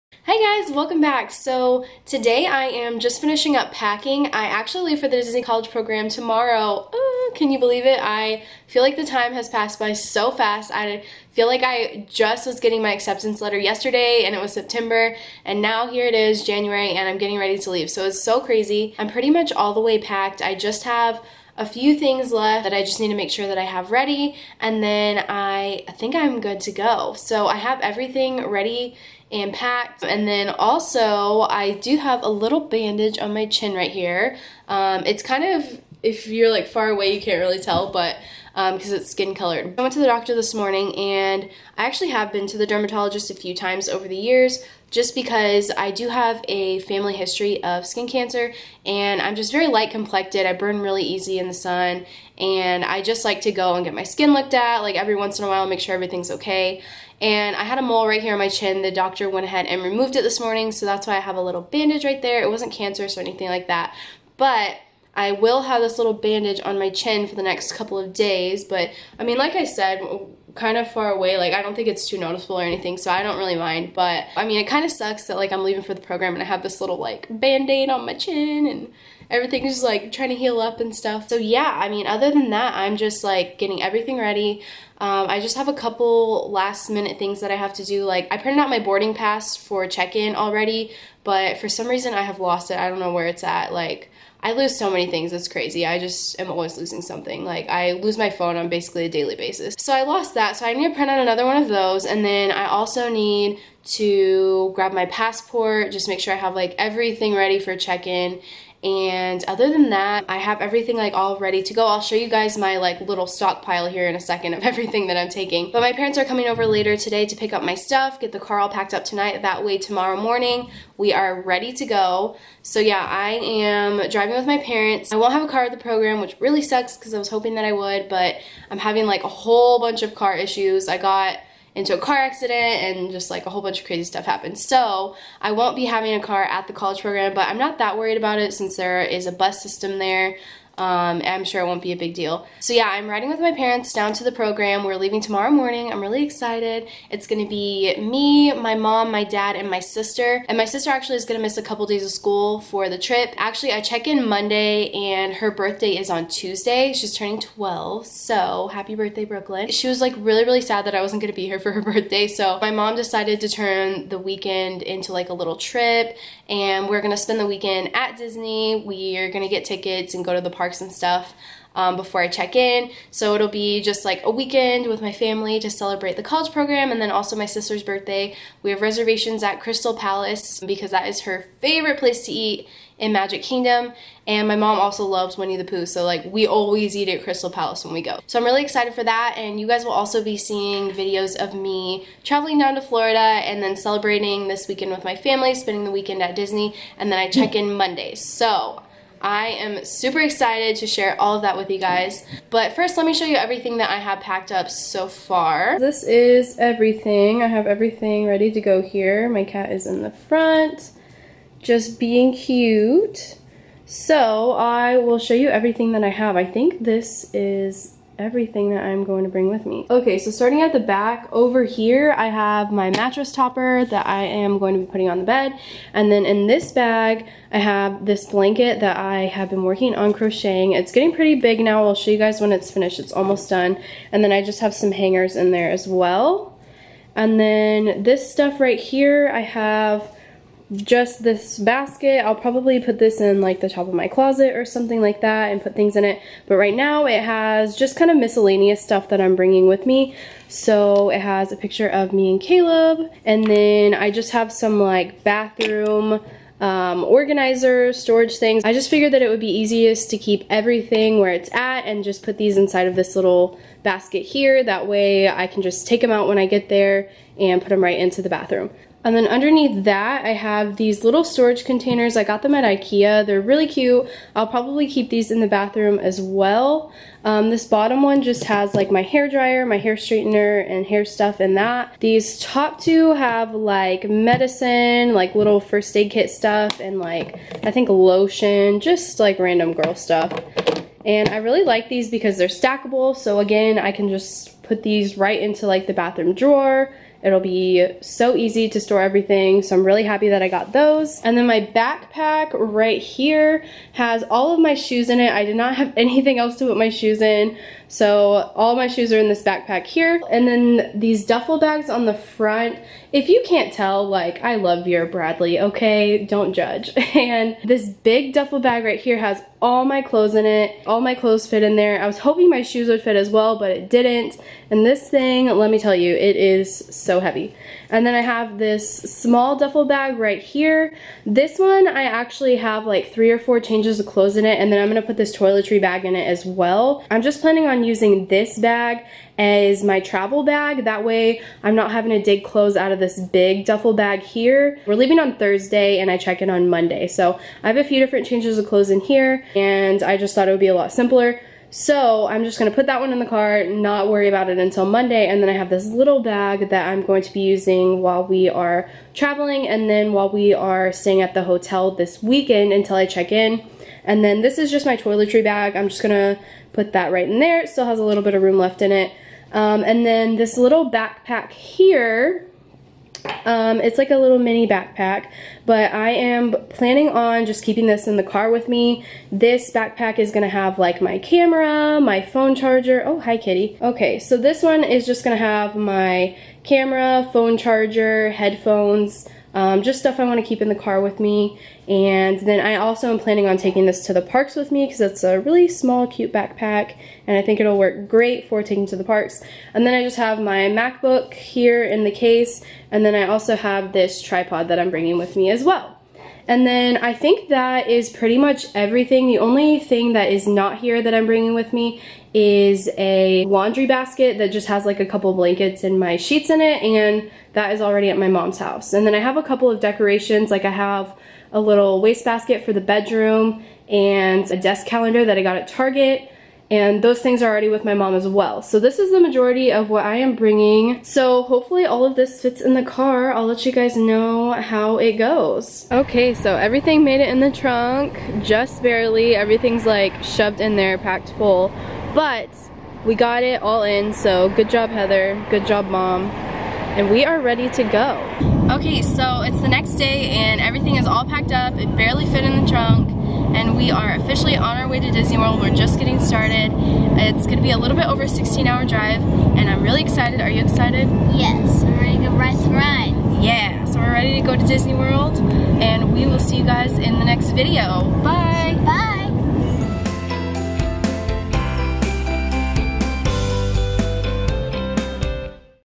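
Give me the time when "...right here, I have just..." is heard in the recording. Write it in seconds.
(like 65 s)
238 s.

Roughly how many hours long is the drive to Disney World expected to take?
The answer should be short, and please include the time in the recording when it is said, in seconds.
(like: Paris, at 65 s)
16 hours, at 458 s.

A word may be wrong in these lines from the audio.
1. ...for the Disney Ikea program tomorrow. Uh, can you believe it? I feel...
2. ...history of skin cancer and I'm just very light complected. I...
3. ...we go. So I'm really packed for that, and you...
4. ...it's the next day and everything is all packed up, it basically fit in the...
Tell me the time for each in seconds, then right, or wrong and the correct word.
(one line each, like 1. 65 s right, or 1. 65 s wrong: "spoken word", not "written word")
1. 4 s wrong: "College", not "Ikea"
2. 47 s right
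3. 187 s wrong: "excited", not "packed"
4. 449 s wrong: "barely", not "basically".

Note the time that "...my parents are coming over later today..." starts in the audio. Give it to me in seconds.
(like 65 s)
115 s.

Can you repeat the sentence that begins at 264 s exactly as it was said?
That way I can just take them out when I get there and put them right into the bathroom.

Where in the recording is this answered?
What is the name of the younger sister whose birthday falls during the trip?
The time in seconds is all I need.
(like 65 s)
159 s.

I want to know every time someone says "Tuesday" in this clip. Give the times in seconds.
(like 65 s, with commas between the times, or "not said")
156 s.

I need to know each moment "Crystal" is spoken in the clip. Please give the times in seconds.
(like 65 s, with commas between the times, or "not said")
179 s, 187 s.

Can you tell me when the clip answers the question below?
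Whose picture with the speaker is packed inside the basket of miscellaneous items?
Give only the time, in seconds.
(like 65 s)
252 s.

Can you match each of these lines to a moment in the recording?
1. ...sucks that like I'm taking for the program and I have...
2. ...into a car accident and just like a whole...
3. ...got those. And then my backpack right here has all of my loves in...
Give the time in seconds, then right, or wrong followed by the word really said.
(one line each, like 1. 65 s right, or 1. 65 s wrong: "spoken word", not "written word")
1. 74 s wrong: "leaving", not "taking"
2. 131 s right
3. 300 s wrong: "shoes", not "loves".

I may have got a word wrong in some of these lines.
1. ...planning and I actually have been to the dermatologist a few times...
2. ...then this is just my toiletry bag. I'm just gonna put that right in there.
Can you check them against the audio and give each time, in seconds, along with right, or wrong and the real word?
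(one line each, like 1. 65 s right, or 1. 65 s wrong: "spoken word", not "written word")
1. 40 s wrong: "morning", not "planning"
2. 364 s right.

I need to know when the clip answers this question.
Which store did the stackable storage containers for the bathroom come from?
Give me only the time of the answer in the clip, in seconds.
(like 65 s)
272 s.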